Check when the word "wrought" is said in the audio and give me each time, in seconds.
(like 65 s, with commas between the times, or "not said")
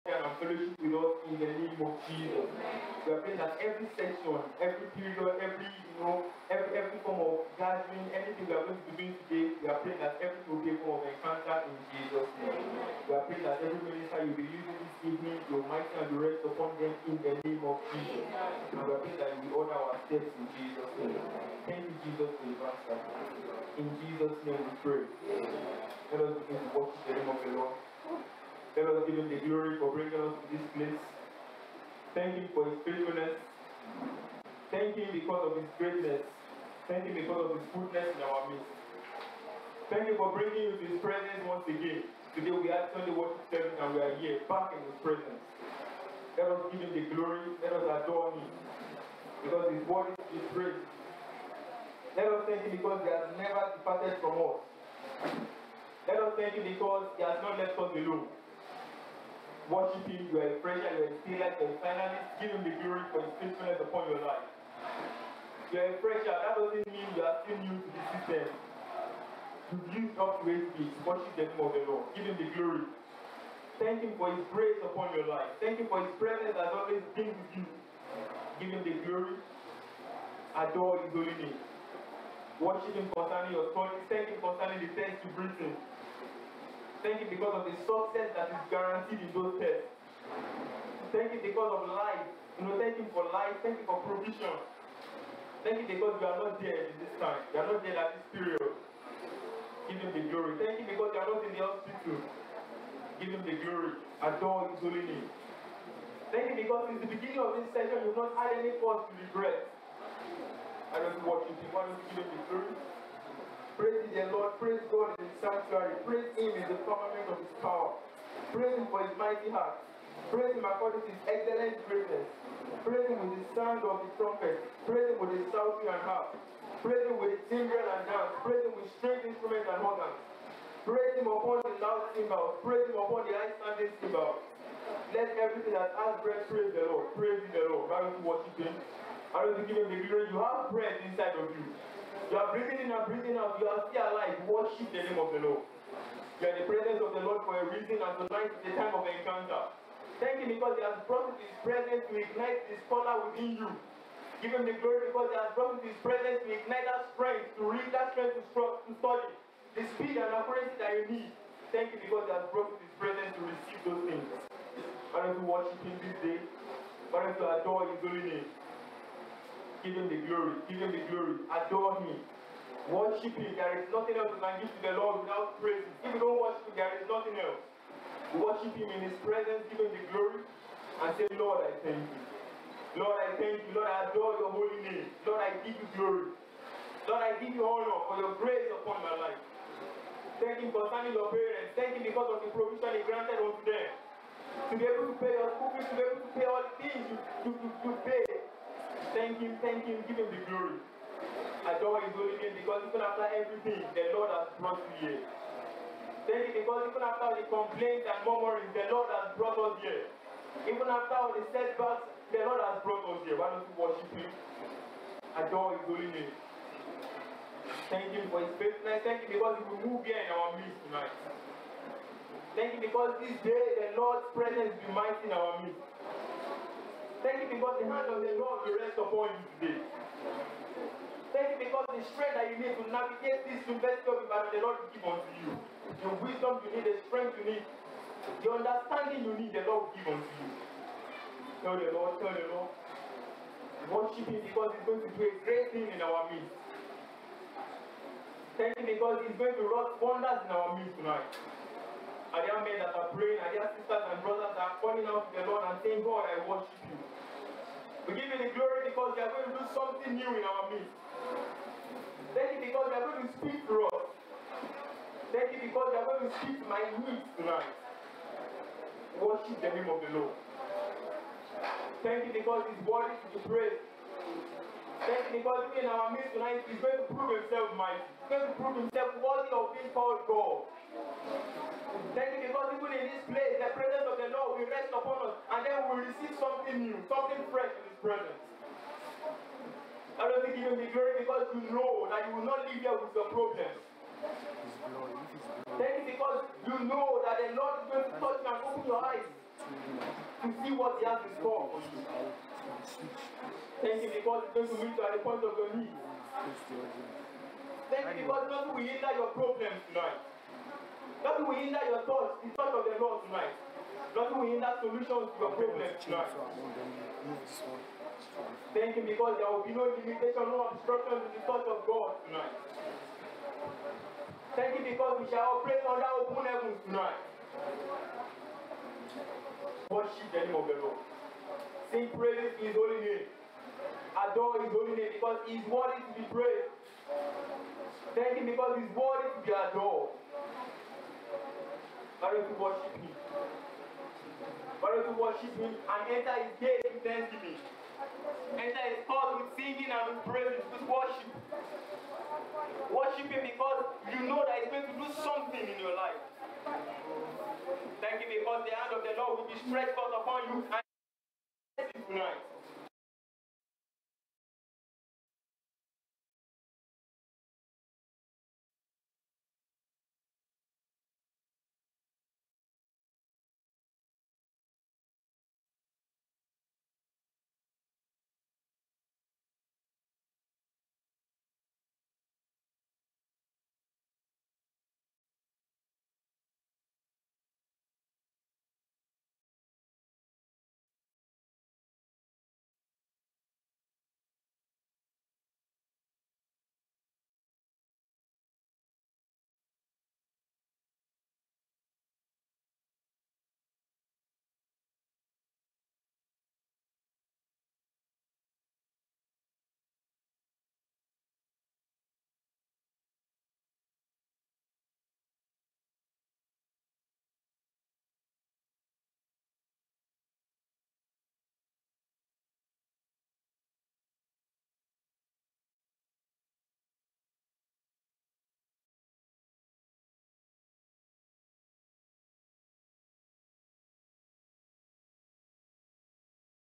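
249 s.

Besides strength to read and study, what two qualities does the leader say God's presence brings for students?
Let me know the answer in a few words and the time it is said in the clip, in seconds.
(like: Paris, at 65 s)
speed and accuracy, at 159 s.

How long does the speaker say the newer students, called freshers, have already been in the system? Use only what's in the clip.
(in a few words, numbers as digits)
8 weeks.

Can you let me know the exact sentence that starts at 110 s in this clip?
I don't know what you think.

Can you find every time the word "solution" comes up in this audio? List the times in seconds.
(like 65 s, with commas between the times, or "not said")
314 s.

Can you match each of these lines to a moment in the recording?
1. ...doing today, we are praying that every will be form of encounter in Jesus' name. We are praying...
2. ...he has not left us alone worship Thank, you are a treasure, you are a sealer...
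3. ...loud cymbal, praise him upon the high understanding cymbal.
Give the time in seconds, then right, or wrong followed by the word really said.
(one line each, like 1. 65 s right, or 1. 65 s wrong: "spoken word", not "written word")
1. 9 s right
2. 57 s wrong: "Him", not "Thank"
3. 131 s wrong: "sounding", not "understanding".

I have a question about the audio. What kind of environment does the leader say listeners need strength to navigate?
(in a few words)
university.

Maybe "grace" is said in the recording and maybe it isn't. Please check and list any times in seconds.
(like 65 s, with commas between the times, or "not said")
74 s, 188 s.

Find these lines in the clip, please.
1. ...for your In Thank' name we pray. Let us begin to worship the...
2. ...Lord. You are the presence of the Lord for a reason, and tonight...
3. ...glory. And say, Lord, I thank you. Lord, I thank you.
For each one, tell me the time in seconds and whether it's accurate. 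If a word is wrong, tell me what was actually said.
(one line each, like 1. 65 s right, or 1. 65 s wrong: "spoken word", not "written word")
1. 22 s wrong: "Jesus", not "Thank"
2. 145 s right
3. 180 s right.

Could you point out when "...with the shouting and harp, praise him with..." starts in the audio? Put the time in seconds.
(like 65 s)
125 s.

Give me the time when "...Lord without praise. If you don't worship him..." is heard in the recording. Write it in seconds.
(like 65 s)
174 s.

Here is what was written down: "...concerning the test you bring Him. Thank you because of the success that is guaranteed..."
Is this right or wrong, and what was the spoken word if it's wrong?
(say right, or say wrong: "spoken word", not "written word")
right.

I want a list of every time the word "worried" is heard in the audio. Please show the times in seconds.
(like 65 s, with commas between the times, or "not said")
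290 s.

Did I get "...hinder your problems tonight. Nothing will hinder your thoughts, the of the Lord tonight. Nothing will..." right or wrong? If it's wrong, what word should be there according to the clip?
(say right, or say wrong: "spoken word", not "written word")
right.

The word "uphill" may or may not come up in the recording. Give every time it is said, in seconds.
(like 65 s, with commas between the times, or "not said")
not said.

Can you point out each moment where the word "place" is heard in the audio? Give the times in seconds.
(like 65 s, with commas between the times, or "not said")
30 s, 283 s.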